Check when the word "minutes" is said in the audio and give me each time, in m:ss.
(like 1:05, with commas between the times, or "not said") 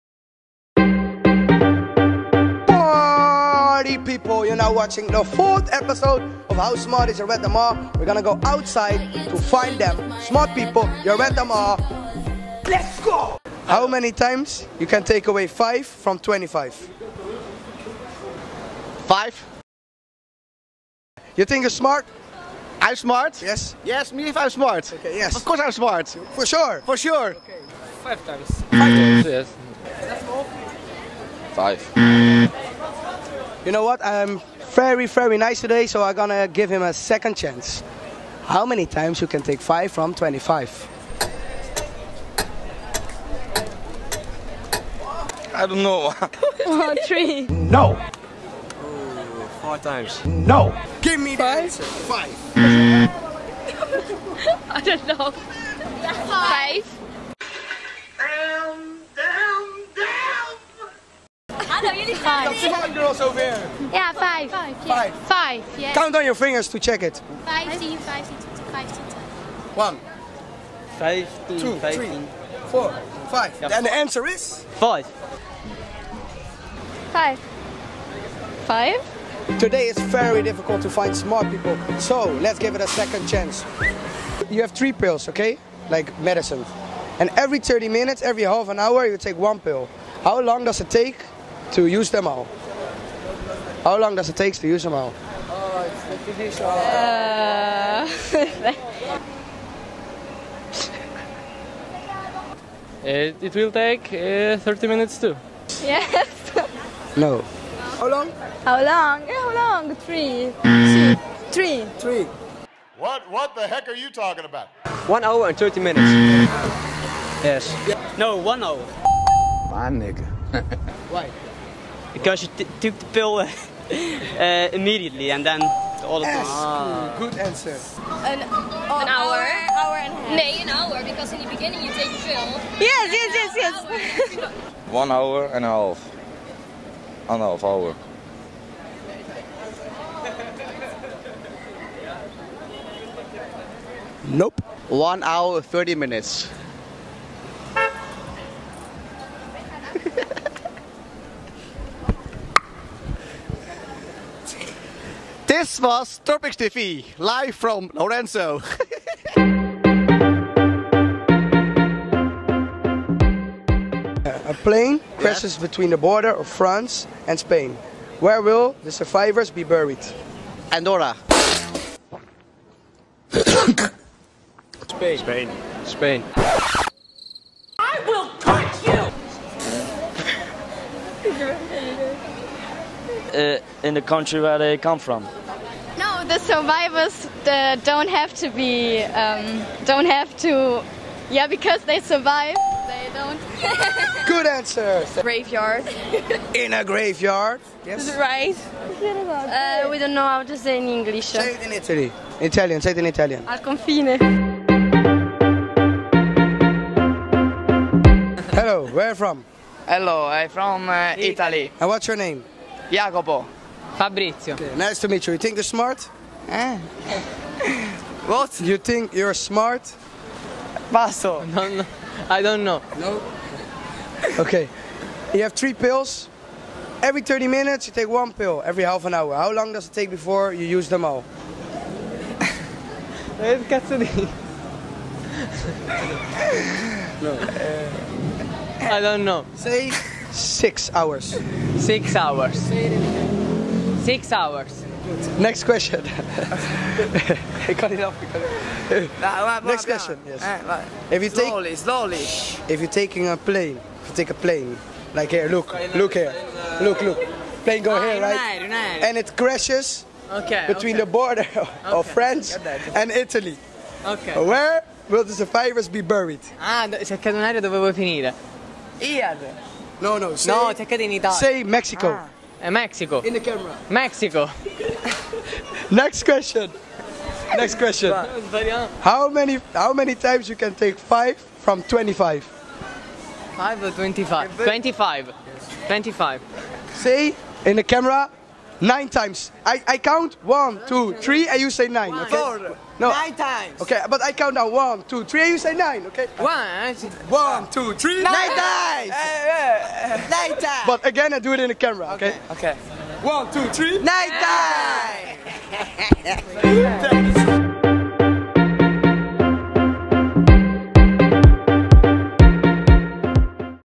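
1:27, 1:44, 1:55, 2:25, 3:47.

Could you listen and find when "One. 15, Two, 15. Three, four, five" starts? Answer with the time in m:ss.
1:09.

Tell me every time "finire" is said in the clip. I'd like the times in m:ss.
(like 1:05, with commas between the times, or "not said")
4:27.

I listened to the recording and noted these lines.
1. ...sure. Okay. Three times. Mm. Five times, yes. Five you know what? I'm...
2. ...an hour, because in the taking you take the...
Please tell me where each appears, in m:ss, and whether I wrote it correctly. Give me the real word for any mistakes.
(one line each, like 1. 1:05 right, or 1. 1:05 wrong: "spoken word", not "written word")
1. 0:26 wrong: "Five", not "Three"
2. 2:10 wrong: "beginning", not "taking".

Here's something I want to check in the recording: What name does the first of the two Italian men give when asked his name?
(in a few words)
Jacopo.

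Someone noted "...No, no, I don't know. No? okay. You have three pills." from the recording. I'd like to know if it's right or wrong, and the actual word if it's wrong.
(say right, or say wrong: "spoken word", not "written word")
right.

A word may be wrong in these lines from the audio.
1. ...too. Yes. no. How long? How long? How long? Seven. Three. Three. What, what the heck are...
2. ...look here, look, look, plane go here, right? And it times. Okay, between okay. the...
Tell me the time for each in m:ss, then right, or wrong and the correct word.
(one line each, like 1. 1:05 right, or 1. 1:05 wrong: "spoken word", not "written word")
1. 1:45 wrong: "Three", not "Seven"
2. 4:15 wrong: "crashes", not "times".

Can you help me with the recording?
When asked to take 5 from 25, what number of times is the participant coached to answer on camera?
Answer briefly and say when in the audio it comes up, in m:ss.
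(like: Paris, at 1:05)
9, at 4:48.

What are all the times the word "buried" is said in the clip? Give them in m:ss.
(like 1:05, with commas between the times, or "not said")
2:49, 4:25.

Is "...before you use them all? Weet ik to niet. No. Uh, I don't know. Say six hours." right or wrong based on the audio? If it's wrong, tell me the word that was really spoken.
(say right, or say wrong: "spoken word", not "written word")
right.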